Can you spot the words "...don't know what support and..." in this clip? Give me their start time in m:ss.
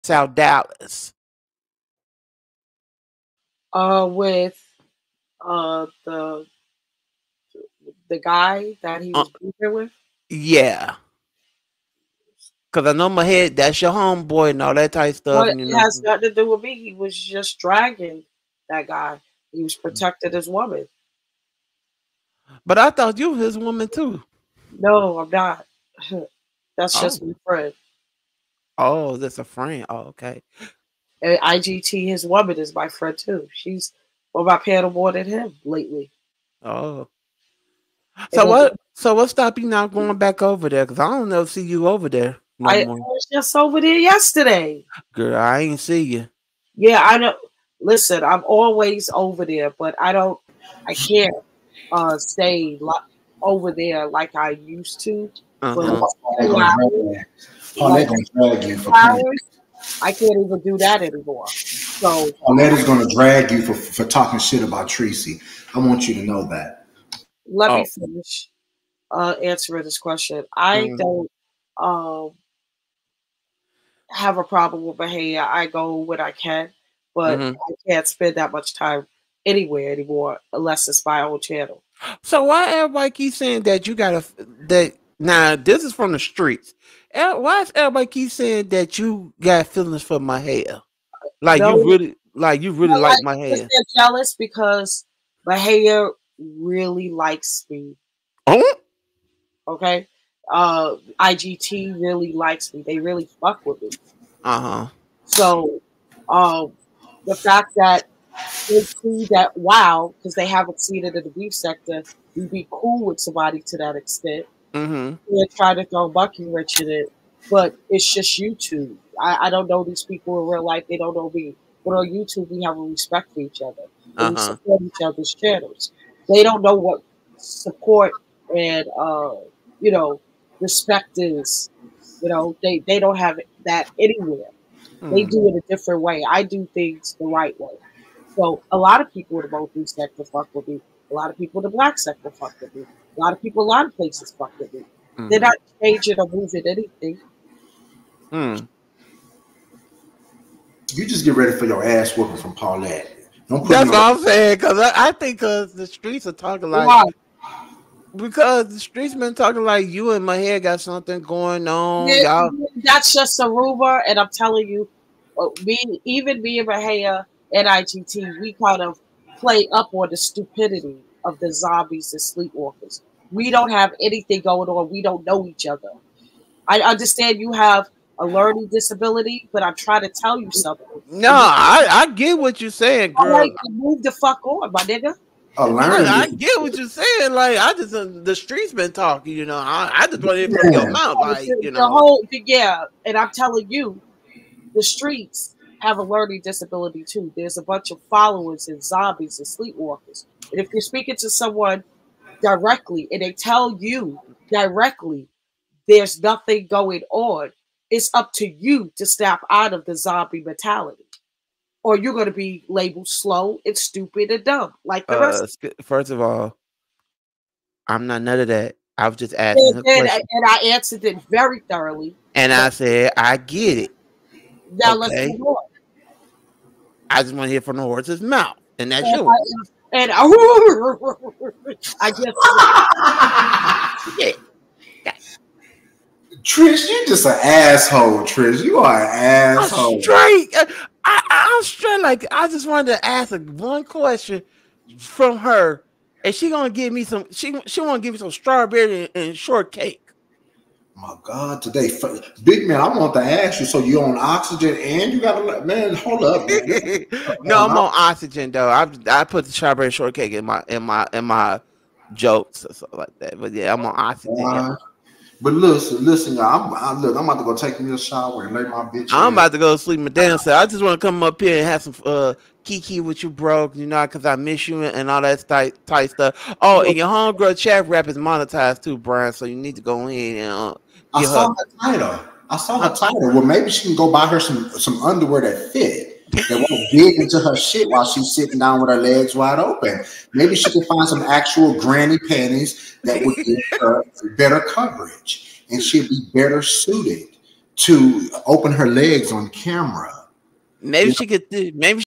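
2:06.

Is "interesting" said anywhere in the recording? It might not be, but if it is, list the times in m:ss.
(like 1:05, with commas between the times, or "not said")
not said.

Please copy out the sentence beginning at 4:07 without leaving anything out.
She she wanna give me some strawberry and, and shortcake.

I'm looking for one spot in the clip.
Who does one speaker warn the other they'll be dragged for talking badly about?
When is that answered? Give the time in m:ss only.
1:04.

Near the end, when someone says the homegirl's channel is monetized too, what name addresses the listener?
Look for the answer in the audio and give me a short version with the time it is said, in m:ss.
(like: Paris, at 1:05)
Brian, at 4:38.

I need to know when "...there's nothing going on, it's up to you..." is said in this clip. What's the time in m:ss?
3:25.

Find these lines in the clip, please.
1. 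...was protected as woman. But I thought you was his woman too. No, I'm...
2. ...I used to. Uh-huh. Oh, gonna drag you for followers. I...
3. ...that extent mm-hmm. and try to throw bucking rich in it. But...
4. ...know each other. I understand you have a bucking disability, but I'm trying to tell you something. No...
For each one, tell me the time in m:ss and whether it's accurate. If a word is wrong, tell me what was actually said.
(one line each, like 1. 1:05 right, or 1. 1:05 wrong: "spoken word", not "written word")
1. 0:19 right
2. 0:54 wrong: "flowers", not "followers"
3. 1:53 right
4. 2:55 wrong: "learning", not "bucking".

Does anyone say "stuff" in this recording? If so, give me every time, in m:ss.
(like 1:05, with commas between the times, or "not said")
0:15, 4:36.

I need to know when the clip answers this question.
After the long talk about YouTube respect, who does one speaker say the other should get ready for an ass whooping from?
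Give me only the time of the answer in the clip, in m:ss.
2:32.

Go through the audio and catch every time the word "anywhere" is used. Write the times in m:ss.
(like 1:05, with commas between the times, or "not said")
1:19, 2:13.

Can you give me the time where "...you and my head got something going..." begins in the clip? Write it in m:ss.
2:39.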